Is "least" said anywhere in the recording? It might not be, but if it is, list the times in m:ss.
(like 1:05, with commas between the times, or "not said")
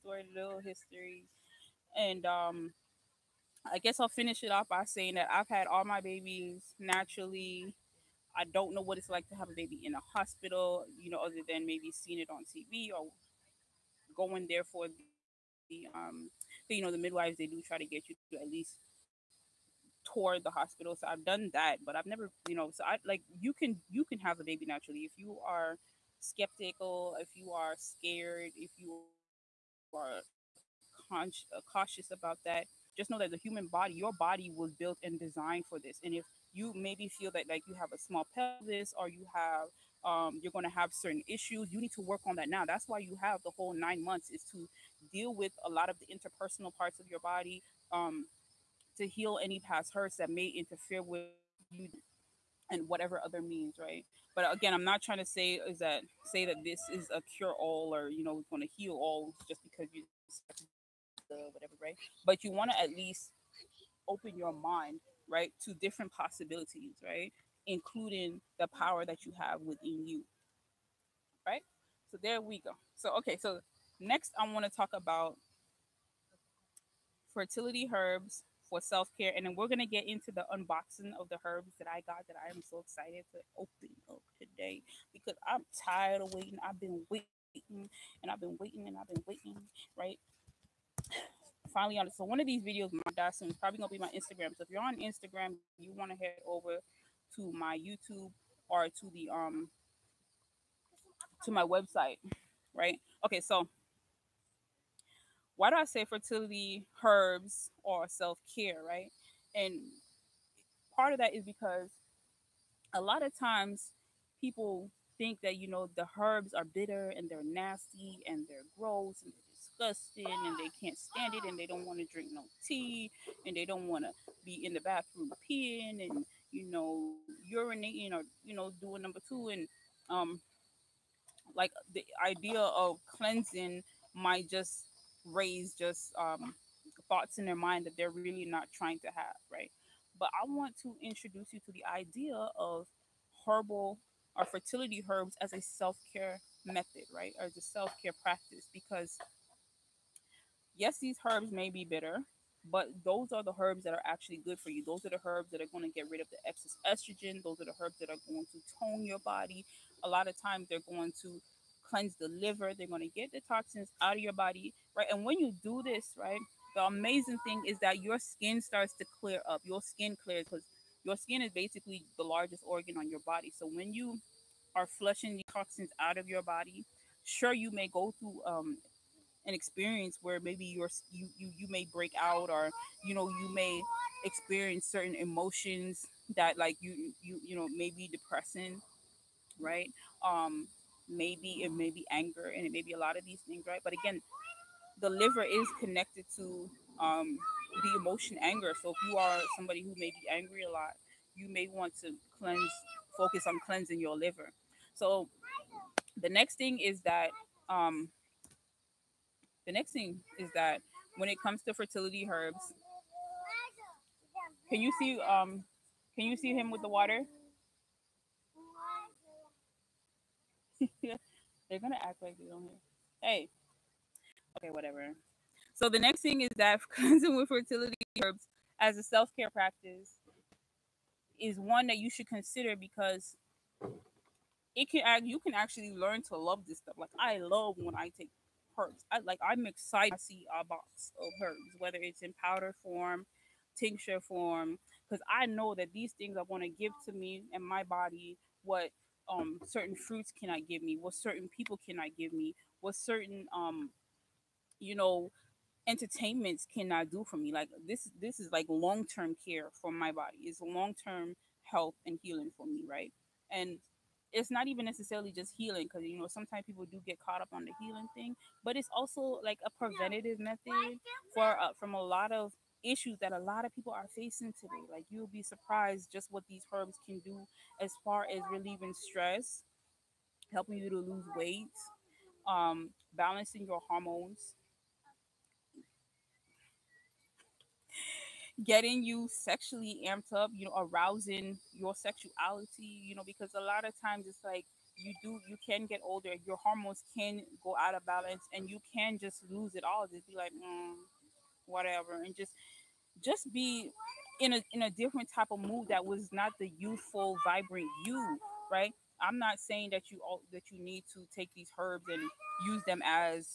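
0:18, 1:02.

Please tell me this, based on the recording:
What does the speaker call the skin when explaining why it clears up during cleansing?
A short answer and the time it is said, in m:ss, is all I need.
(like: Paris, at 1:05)
largest organ, at 2:52.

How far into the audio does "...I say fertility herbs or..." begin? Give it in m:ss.
1:45.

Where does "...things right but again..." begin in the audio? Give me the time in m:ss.
3:13.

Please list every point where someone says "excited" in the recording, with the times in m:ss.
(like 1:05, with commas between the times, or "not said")
1:22, 3:59.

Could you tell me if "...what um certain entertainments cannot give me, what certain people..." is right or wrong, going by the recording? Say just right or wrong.
wrong.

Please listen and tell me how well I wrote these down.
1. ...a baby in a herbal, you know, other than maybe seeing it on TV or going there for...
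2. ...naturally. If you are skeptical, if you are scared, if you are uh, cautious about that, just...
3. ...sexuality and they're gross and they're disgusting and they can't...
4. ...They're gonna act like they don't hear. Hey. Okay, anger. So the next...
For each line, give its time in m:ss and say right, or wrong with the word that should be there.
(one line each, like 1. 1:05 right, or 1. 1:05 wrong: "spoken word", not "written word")
1. 0:09 wrong: "hospital", not "herbal"
2. 0:24 right
3. 1:57 wrong: "nasty", not "sexuality"
4. 3:40 wrong: "whatever", not "anger".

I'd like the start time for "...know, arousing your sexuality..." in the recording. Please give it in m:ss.
4:50.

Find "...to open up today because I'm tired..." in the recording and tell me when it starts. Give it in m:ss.
1:23.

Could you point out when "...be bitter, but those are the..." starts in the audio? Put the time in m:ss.
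2:31.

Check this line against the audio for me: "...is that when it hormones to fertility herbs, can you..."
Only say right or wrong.
wrong.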